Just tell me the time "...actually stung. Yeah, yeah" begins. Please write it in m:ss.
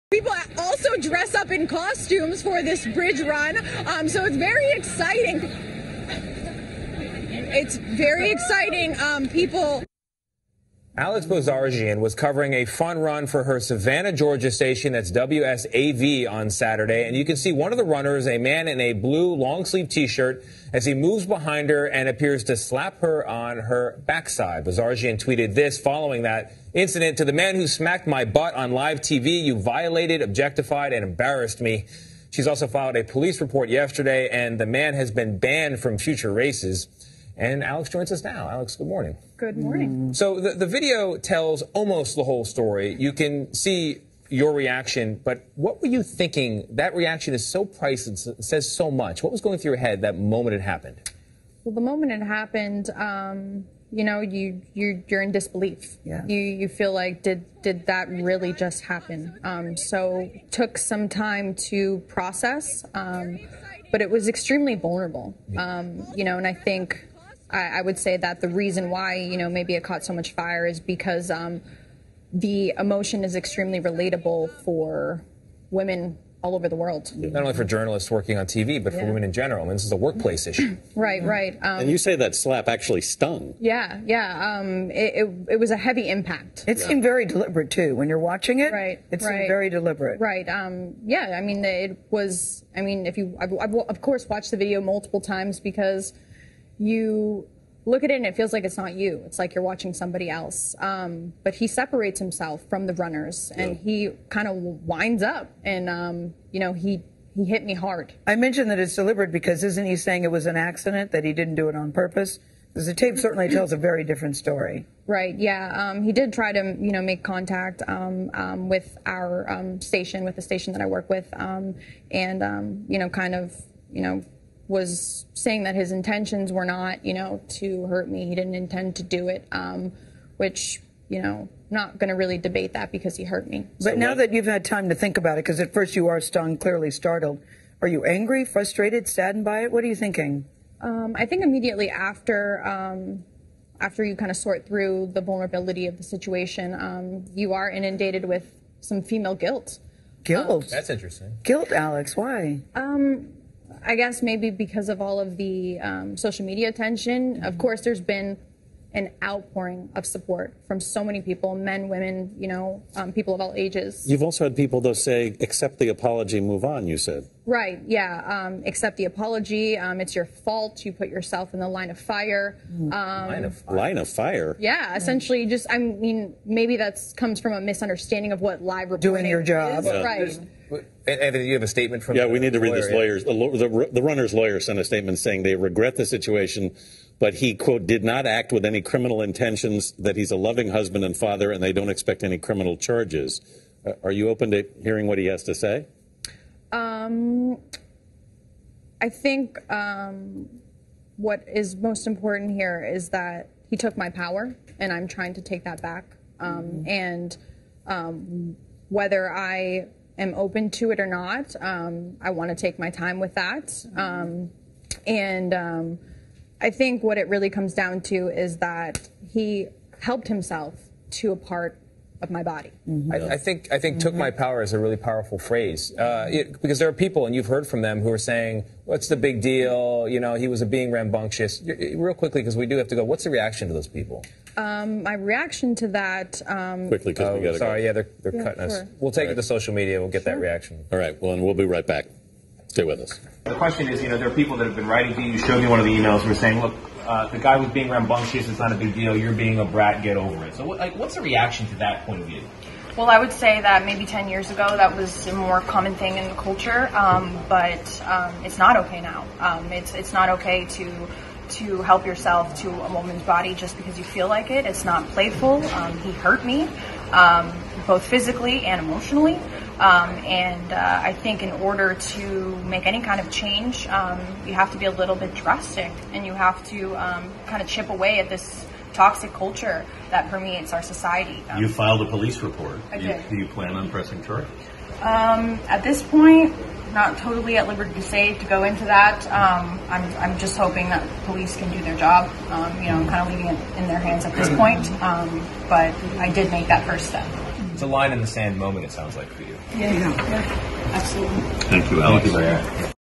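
1:22.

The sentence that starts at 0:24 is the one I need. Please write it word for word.
Bozarjian tweeted this following that incident to the man who smacked my butt on live TV.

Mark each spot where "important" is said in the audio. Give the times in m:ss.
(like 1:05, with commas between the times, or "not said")
3:22.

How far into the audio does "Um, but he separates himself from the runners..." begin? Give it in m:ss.
1:40.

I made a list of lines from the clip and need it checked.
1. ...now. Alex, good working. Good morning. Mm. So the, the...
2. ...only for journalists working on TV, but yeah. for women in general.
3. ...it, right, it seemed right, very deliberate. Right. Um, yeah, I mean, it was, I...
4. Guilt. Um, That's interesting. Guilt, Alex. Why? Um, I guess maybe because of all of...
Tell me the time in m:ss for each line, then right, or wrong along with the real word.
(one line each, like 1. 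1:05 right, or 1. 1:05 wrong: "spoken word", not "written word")
1. 0:38 wrong: "morning", not "working"
2. 1:17 right
3. 1:28 right
4. 2:30 right.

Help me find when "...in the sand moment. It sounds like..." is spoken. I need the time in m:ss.
4:58.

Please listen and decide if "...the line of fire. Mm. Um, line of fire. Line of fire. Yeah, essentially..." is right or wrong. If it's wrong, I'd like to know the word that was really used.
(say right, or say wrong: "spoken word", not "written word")
right.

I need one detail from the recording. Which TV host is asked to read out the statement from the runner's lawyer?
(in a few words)
Anthony.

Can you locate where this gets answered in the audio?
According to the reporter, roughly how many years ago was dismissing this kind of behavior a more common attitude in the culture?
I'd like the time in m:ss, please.
4:14.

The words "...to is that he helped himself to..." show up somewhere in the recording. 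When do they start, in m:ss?
3:38.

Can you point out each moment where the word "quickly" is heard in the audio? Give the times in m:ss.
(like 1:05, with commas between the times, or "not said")
3:52, 3:56.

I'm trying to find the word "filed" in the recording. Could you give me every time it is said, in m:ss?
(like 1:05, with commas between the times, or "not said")
0:32, 4:41.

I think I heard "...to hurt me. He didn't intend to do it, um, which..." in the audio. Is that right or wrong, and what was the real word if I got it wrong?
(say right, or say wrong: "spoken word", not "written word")
right.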